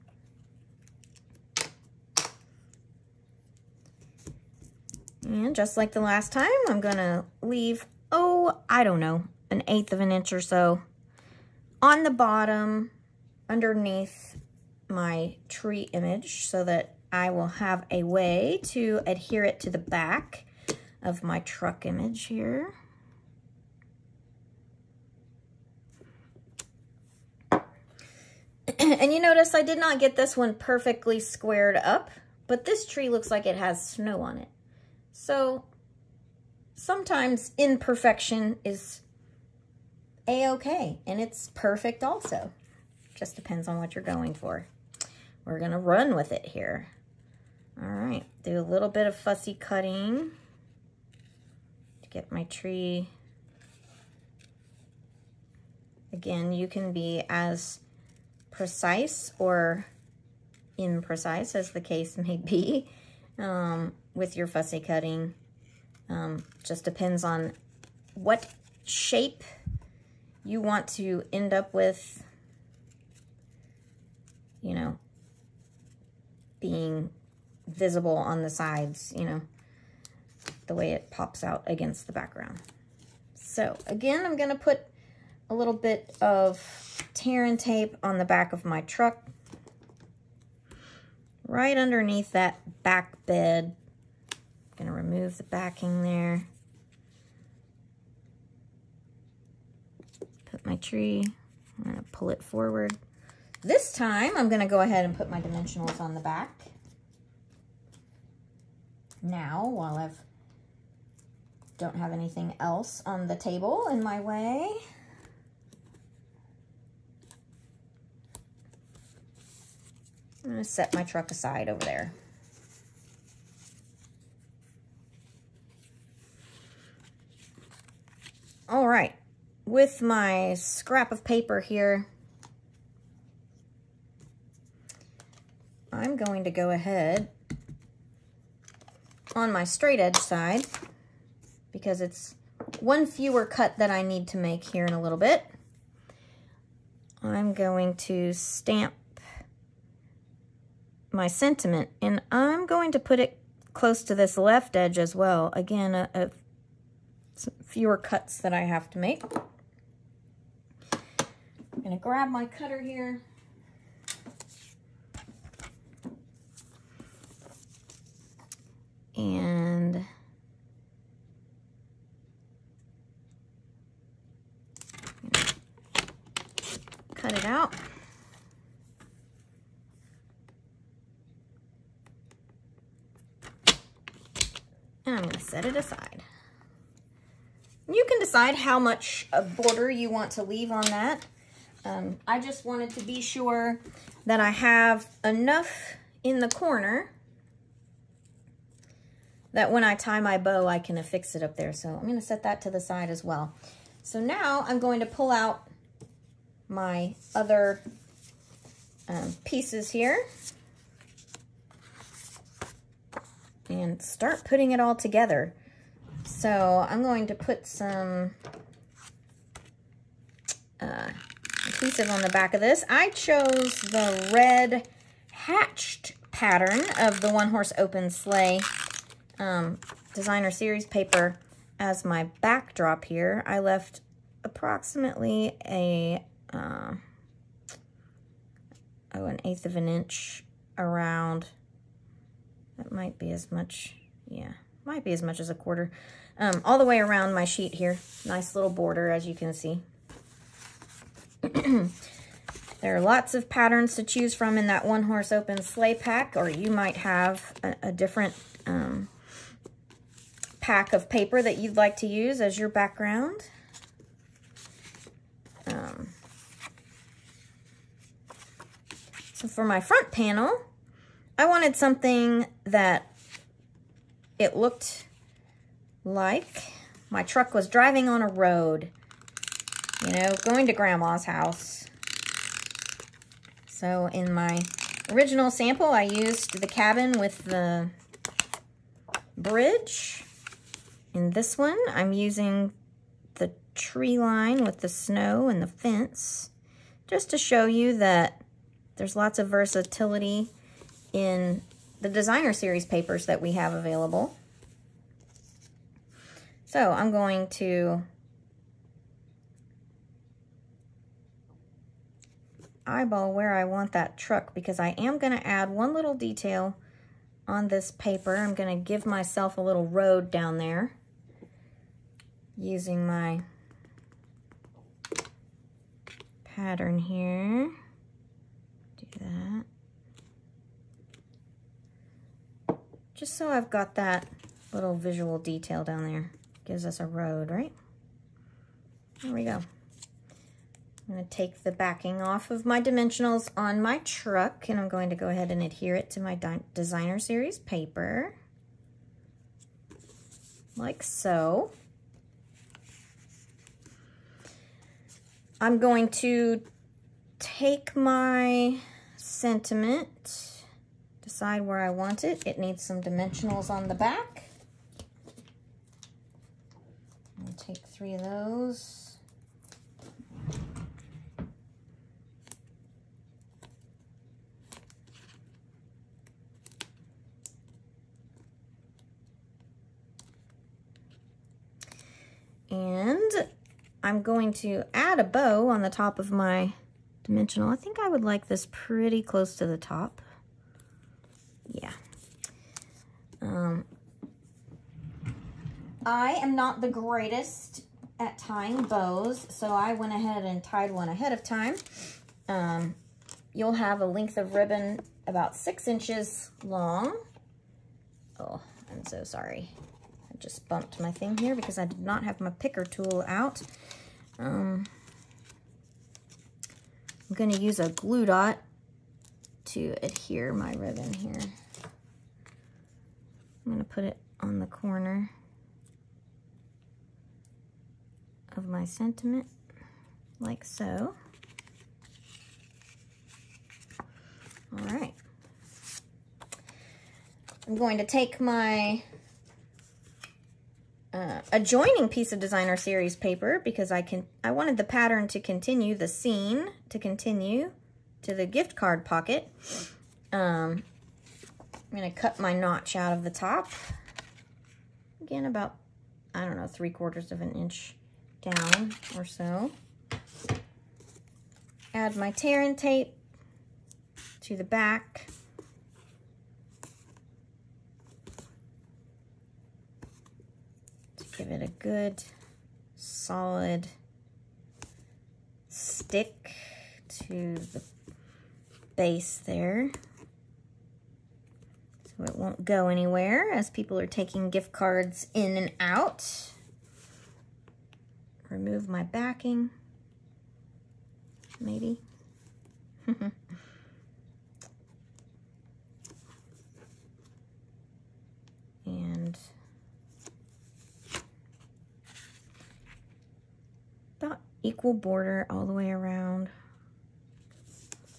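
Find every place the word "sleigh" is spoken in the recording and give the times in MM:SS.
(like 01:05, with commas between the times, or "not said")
03:48, 04:15.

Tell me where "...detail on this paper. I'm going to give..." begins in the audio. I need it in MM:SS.
05:16.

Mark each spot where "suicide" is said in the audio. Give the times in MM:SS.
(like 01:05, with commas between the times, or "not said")
not said.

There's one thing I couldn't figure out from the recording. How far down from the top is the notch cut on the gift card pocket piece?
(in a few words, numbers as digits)
3/4 inch.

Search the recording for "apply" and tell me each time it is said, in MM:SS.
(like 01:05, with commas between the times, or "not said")
not said.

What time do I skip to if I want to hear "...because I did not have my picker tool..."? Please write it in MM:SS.
06:51.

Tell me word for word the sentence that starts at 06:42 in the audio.
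Um, you'll have a length of ribbon about six inches long.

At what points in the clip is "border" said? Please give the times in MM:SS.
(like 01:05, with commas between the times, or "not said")
03:09, 04:08, 08:24.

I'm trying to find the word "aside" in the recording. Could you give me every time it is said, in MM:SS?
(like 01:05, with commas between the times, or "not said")
02:01, 03:05.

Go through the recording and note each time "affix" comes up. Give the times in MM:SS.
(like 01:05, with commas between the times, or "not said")
03:20.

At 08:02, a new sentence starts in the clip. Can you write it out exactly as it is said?
So it won't go anywhere as people are taking gift cards in and out remove my backing, maybe.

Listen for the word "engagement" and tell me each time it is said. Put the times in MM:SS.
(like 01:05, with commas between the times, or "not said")
not said.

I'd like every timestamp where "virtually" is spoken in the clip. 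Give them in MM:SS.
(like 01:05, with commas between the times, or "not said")
not said.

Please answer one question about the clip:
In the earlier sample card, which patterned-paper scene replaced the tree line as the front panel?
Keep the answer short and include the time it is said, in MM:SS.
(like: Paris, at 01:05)
the cabin with the bridge, at 04:46.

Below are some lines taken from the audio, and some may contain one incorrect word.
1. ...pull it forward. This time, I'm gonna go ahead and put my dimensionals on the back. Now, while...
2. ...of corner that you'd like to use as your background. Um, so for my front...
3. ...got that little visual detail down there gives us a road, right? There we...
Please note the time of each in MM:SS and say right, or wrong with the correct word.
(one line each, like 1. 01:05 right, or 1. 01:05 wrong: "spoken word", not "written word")
1. 01:42 right
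2. 04:20 wrong: "paper", not "corner"
3. 05:33 right.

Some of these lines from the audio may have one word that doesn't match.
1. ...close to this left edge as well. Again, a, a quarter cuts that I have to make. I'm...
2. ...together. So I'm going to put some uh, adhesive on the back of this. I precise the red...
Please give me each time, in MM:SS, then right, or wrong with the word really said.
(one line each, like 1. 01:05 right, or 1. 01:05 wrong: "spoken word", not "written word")
1. 02:33 wrong: "fewer", not "quarter"
2. 03:34 wrong: "chose", not "precise".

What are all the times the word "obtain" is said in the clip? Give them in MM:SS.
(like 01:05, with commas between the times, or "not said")
not said.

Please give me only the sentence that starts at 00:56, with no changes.
Again, you can be as precise or imprecise as the case may be.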